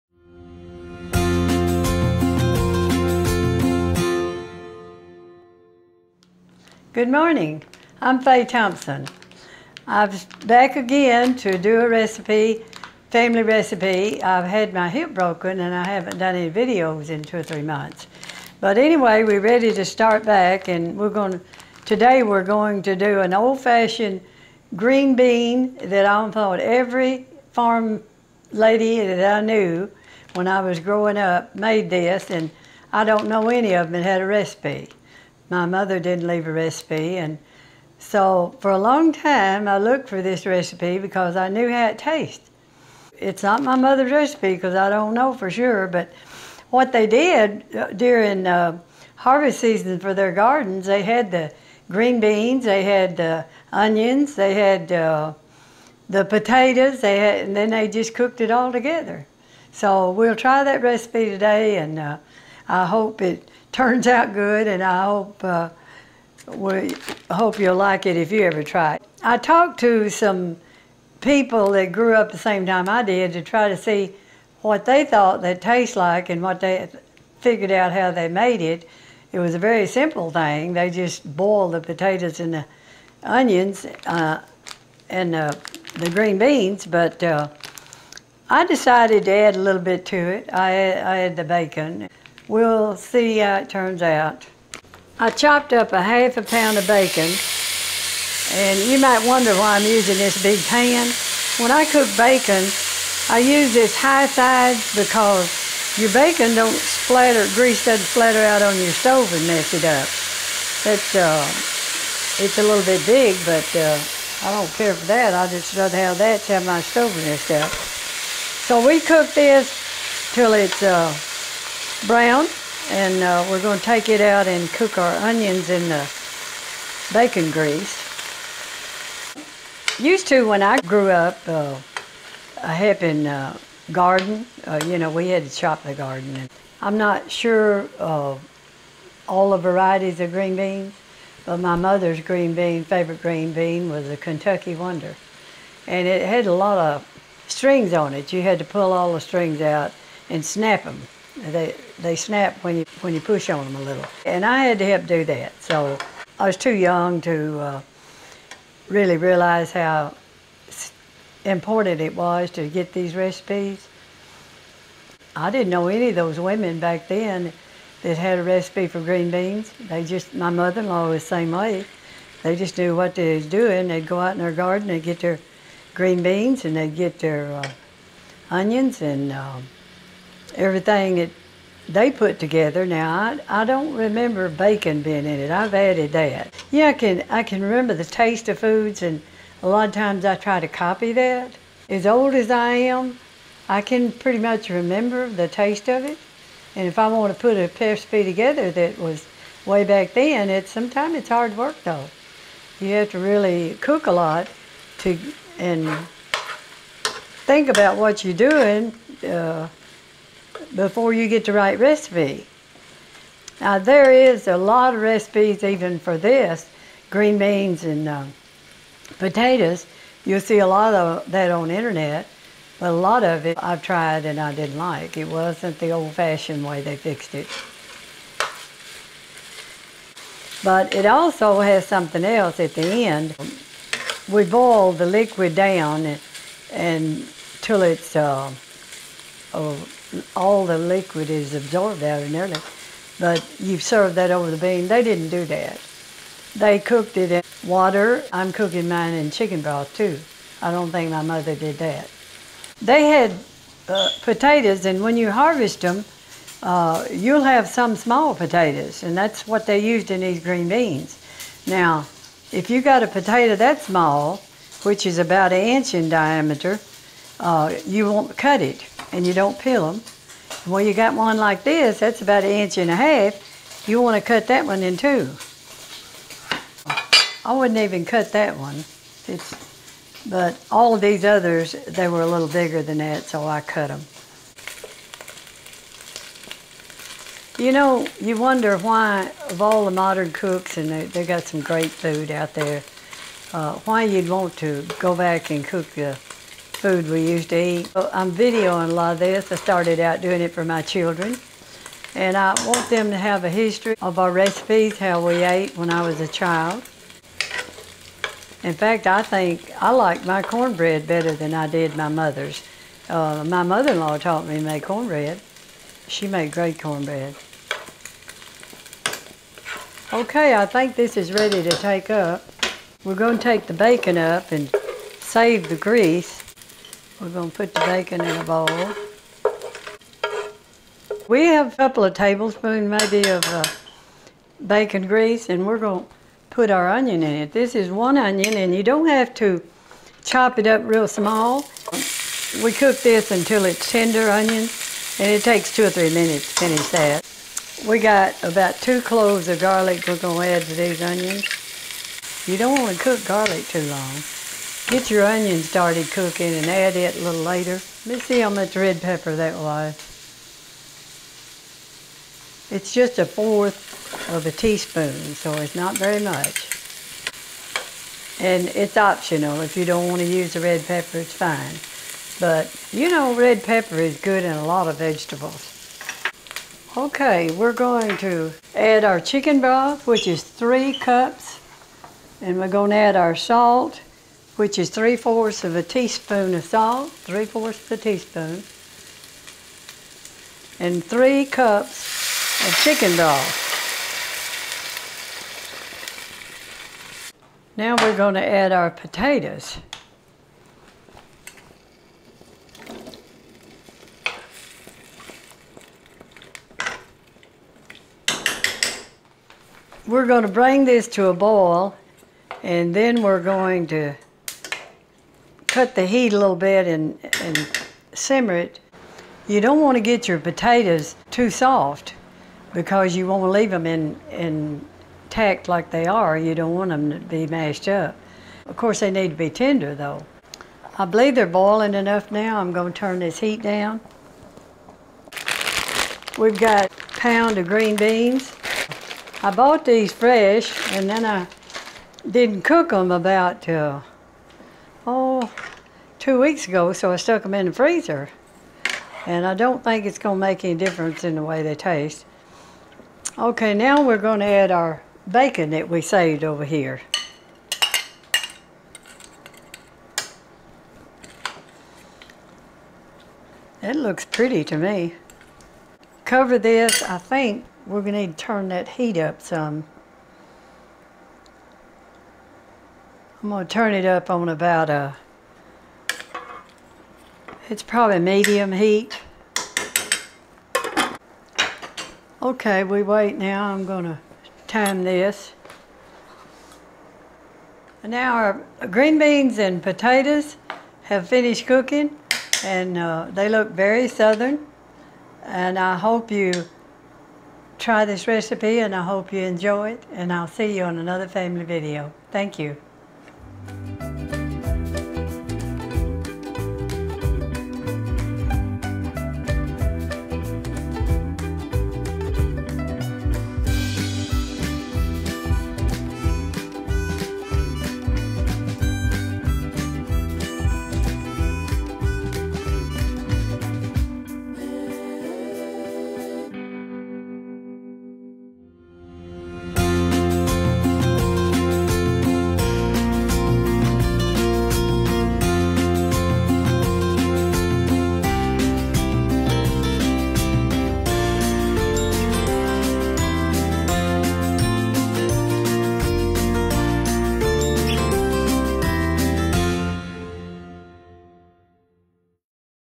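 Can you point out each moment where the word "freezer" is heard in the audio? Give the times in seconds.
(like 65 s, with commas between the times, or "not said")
447 s.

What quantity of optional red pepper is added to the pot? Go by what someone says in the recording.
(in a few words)
1/4 teaspoon.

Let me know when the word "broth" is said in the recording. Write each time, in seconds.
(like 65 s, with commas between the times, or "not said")
249 s, 379 s, 393 s.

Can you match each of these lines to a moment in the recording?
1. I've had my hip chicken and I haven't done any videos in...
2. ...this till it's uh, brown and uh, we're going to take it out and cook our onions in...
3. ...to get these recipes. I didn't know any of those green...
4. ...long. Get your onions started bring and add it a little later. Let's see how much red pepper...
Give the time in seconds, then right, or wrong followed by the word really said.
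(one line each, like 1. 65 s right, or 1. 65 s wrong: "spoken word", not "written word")
1. 14 s wrong: "broken", not "chicken"
2. 119 s right
3. 162 s wrong: "women", not "green"
4. 353 s wrong: "cooking", not "bring".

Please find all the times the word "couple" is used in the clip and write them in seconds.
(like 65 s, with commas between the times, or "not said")
331 s.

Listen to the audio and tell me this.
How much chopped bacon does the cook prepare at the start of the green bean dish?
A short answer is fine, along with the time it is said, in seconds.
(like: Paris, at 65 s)
half a pound, at 95 s.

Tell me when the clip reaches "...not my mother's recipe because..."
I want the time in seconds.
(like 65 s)
43 s.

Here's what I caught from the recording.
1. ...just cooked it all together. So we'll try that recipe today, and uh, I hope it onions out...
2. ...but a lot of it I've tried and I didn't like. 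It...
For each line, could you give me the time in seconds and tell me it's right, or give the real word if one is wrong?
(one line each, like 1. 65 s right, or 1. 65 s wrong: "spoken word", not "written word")
1. 57 s wrong: "turns", not "onions"
2. 222 s right.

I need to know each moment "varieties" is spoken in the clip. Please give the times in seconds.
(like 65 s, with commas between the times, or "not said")
139 s.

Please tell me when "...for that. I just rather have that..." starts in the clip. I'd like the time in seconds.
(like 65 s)
114 s.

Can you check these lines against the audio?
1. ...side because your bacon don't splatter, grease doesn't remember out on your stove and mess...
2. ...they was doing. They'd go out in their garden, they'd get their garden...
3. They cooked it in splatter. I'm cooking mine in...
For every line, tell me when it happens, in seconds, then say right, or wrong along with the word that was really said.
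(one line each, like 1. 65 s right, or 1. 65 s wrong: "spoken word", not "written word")
1. 104 s wrong: "splatter", not "remember"
2. 173 s wrong: "green", not "garden"
3. 246 s wrong: "water", not "splatter".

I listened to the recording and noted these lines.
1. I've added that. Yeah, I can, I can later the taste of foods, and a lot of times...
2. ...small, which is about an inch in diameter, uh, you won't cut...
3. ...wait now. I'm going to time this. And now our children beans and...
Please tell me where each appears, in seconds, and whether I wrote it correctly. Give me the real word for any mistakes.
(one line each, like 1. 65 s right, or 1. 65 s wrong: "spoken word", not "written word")
1. 185 s wrong: "remember", not "later"
2. 263 s right
3. 483 s wrong: "green", not "children".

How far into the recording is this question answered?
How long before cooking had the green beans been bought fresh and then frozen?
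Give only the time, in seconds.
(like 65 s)
446 s.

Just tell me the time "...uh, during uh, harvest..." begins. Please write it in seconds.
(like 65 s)
47 s.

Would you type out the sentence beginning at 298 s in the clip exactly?
I'm videoing a lot of this.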